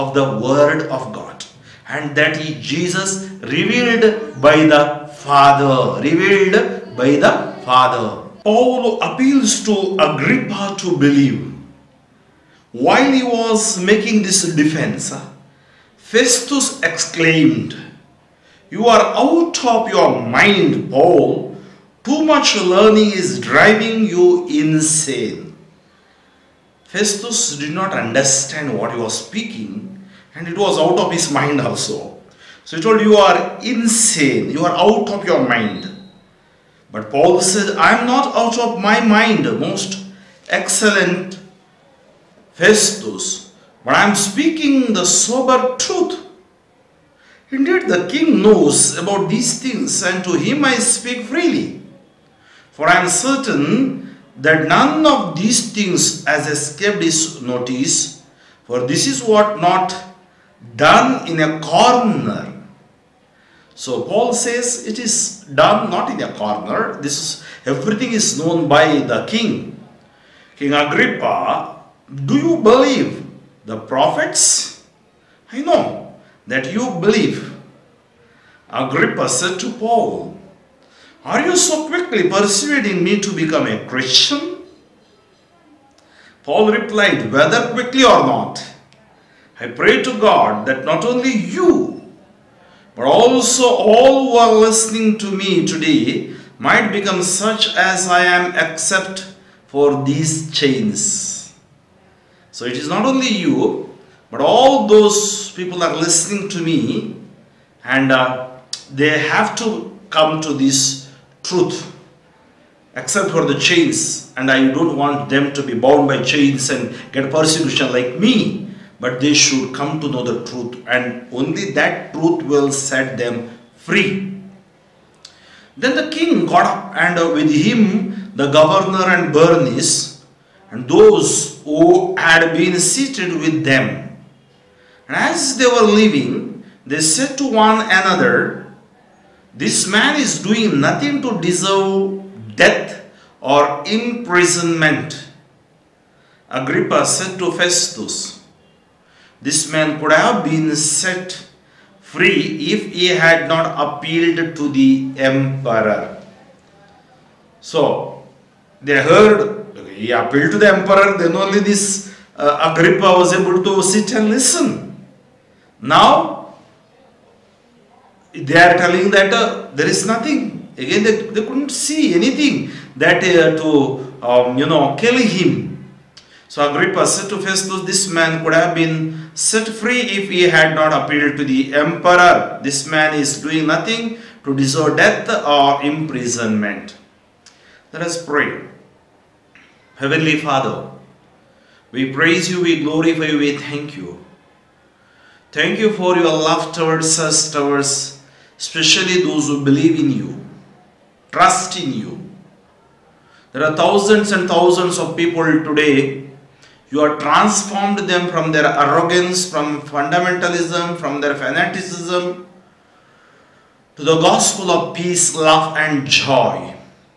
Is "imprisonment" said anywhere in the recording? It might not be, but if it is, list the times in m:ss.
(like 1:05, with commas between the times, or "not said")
2:23, 3:05.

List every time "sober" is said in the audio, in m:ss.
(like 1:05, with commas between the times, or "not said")
0:45.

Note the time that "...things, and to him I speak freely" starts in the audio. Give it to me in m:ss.
0:49.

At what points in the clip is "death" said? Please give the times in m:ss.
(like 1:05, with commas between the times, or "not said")
2:22, 3:04.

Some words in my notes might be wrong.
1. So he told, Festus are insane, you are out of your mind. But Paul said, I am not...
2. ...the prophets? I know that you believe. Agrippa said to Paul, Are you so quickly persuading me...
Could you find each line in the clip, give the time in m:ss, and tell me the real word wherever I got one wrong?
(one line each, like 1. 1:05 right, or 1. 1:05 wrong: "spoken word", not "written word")
1. 0:32 wrong: "You", not "Festus"
2. 1:13 right.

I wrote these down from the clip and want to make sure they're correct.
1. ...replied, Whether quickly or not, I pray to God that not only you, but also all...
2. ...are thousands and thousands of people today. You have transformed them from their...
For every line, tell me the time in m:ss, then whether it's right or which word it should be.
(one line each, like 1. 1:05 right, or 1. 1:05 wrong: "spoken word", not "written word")
1. 1:26 right
2. 3:23 right.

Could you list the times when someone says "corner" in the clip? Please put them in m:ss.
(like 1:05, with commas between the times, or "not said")
1:01, 1:06.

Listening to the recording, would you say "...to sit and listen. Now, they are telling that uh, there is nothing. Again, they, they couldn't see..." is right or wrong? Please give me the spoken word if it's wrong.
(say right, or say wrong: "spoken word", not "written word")
right.